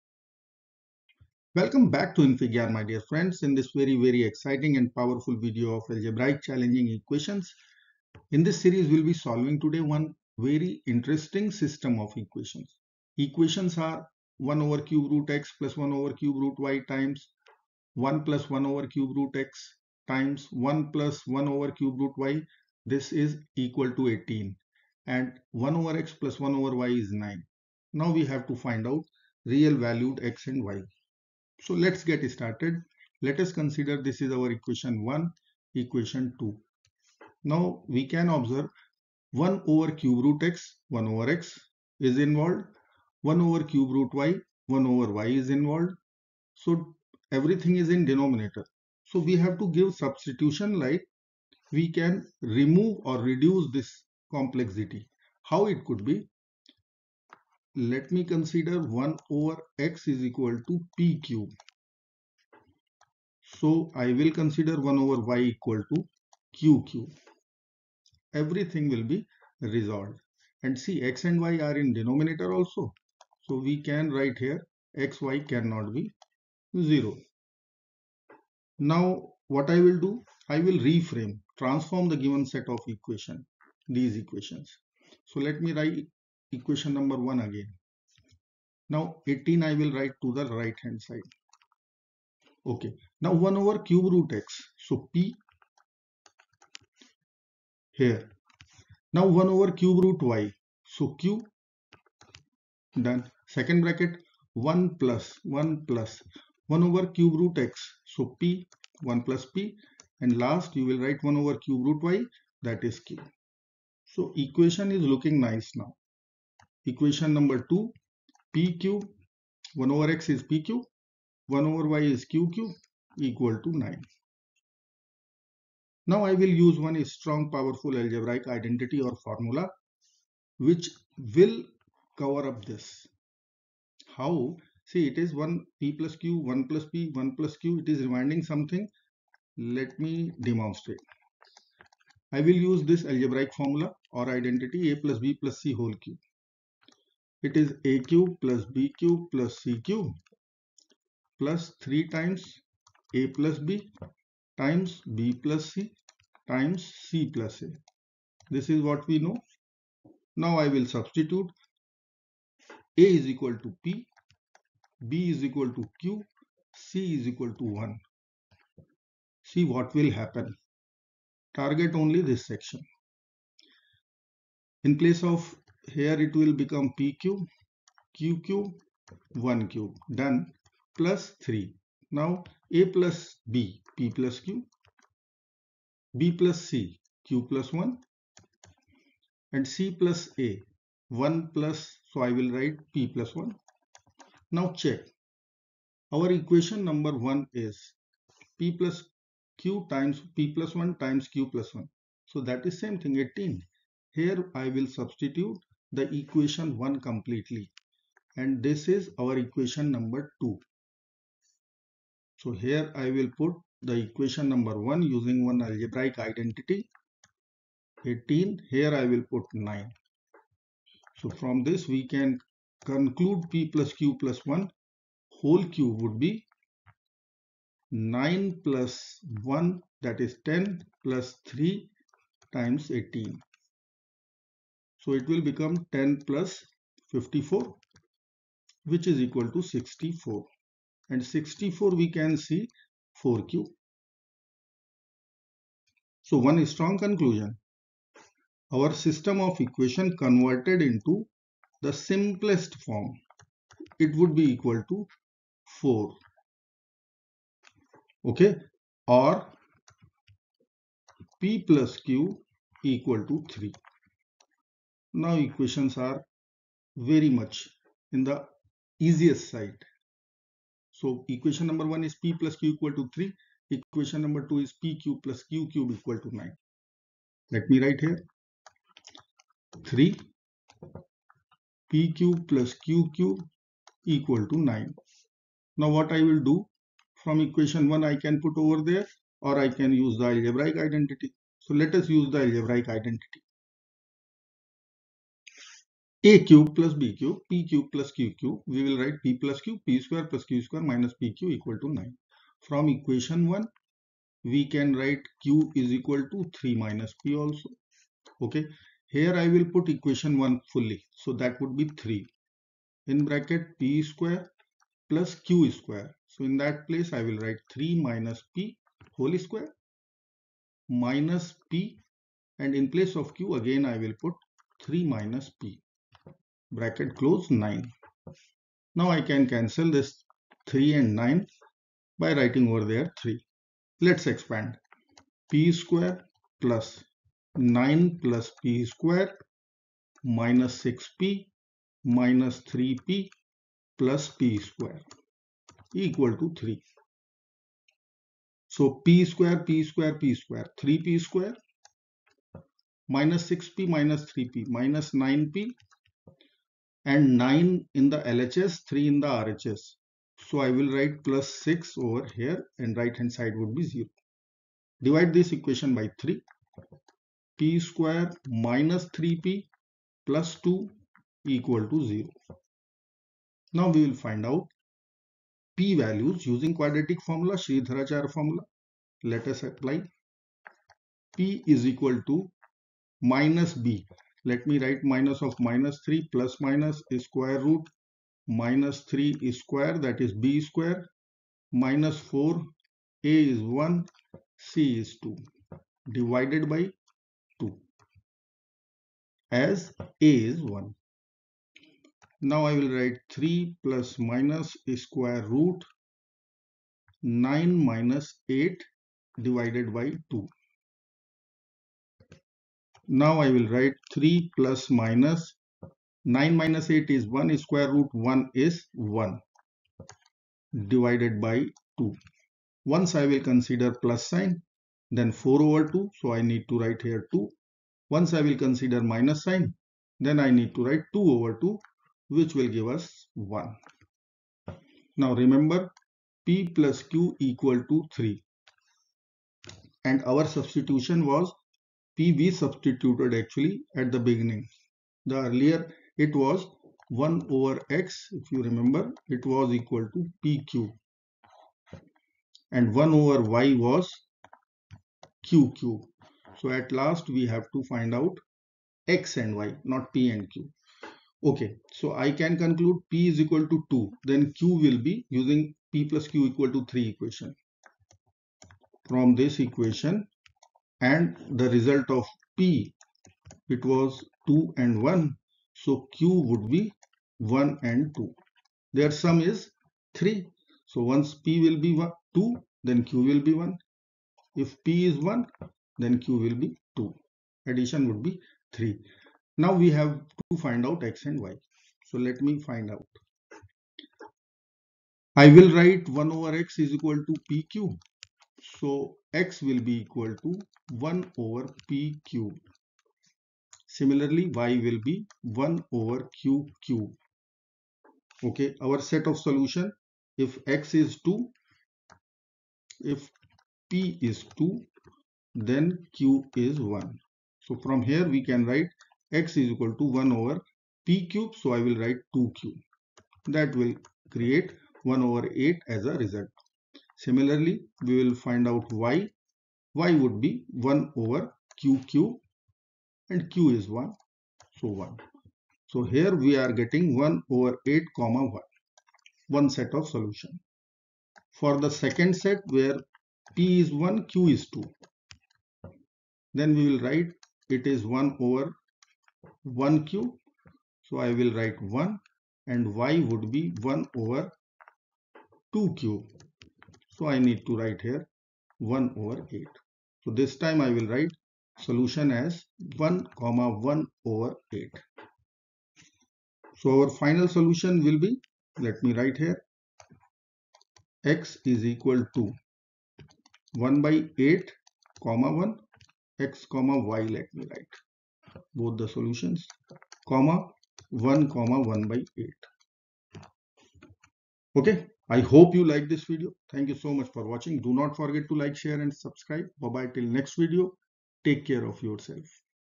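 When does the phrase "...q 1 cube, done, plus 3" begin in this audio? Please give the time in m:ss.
2:58.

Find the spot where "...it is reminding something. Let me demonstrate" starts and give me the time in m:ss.
2:17.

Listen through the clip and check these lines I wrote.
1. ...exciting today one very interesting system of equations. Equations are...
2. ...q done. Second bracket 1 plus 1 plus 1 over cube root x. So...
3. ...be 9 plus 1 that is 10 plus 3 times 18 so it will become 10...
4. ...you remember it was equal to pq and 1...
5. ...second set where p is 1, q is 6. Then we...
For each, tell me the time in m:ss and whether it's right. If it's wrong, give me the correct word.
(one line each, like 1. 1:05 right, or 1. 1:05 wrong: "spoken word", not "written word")
1. 0:09 wrong: "solving", not "exciting"
2. 1:41 right
3. 3:46 right
4. 7:28 right
5. 9:01 wrong: "2", not "6".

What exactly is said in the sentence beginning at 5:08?
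Okay, here I will put equation 1 fully.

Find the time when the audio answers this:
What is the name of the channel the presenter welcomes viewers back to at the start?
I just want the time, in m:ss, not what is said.
0:02.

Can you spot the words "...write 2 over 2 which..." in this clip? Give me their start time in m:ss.
7:10.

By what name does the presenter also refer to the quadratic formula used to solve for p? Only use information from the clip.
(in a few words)
Sridharachar formula.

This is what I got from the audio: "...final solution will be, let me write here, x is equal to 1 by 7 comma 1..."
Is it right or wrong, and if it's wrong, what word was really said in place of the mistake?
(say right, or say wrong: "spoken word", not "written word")
wrong: "8", not "7".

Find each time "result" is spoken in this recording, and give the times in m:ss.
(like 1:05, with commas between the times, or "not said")
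7:51, 8:46.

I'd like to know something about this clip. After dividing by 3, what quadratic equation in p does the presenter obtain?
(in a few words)
p^2 - 3p + 2 = 0.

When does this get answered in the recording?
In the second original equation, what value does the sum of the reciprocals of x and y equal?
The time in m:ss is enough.
0:25.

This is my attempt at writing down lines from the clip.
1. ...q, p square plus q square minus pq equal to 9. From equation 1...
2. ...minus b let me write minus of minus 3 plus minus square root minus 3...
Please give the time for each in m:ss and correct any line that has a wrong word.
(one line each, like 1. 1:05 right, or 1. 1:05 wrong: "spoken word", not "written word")
1. 4:59 right
2. 6:23 right.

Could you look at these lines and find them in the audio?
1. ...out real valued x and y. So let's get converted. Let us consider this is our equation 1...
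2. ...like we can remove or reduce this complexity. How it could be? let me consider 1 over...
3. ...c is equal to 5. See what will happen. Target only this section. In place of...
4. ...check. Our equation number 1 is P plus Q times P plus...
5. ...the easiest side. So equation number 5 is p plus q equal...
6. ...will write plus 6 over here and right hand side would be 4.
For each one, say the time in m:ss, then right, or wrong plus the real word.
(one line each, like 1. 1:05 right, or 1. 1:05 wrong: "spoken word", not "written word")
1. 0:28 wrong: "started", not "converted"
2. 0:50 right
3. 2:46 wrong: "1", not "5"
4. 3:14 right
5. 4:28 wrong: "1", not "5"
6. 6:00 wrong: "0", not "4".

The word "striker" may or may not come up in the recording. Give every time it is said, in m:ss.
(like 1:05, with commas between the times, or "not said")
not said.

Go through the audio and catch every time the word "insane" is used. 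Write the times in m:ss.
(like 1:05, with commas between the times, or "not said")
not said.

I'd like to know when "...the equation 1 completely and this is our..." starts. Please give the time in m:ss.
3:25.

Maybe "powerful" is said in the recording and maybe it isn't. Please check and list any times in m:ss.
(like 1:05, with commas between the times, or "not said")
0:04, 2:07.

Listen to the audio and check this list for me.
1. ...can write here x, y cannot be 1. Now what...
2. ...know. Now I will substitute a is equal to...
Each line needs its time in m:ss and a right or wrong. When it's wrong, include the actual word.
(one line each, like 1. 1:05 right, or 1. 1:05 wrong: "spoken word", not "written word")
1. 1:13 wrong: "0", not "1"
2. 2:39 right.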